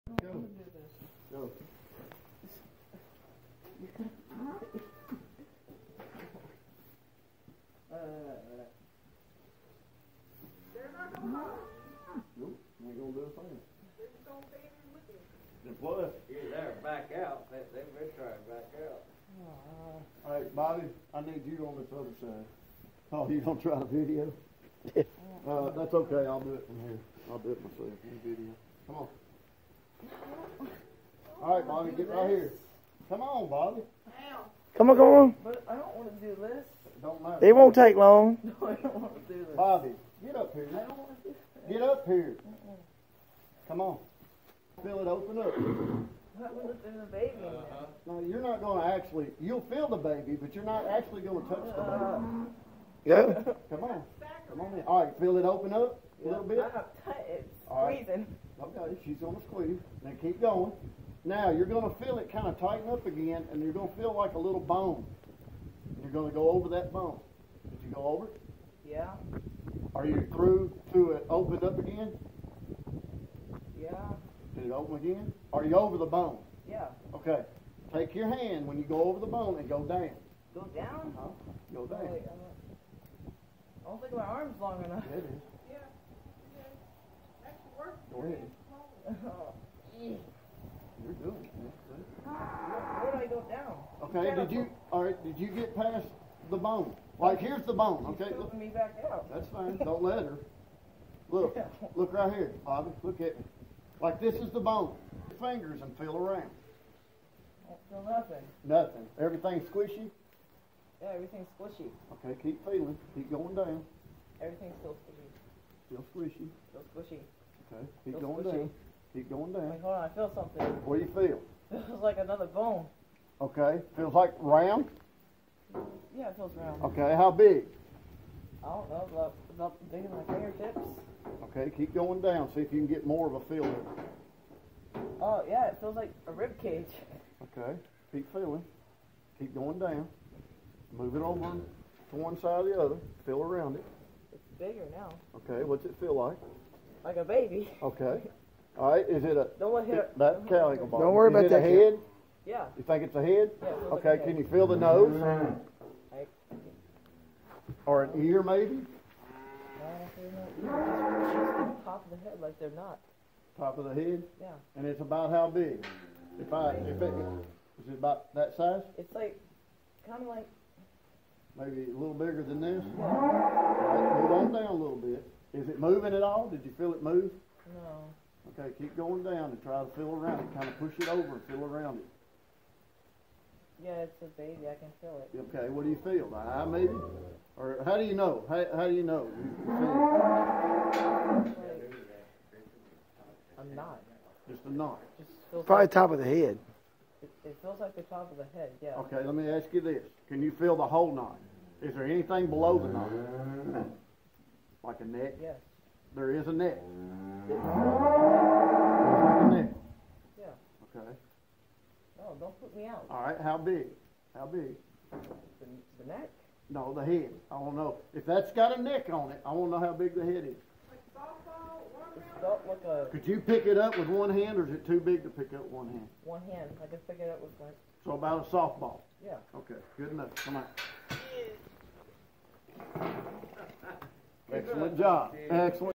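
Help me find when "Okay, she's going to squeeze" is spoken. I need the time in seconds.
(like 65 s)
58 s.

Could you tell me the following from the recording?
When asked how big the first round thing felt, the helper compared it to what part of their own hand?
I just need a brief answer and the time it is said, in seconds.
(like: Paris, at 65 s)
Fingertips, at 130 s.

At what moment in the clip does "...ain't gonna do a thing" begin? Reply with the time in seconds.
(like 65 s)
12 s.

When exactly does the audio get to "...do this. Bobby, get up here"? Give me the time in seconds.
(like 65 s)
39 s.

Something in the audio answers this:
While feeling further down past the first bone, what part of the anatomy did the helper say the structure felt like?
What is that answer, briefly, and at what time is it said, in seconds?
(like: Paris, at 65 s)
Rib cage, at 136 s.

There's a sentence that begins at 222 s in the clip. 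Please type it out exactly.
Like a, Could you pick it up with one hand, or is it too big to pick up one hand?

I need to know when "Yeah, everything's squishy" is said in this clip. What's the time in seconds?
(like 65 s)
111 s.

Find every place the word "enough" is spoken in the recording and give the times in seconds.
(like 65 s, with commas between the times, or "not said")
84 s, 230 s.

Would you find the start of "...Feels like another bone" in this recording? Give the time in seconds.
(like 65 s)
121 s.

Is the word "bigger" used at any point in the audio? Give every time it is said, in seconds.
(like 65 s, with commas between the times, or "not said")
144 s, 172 s.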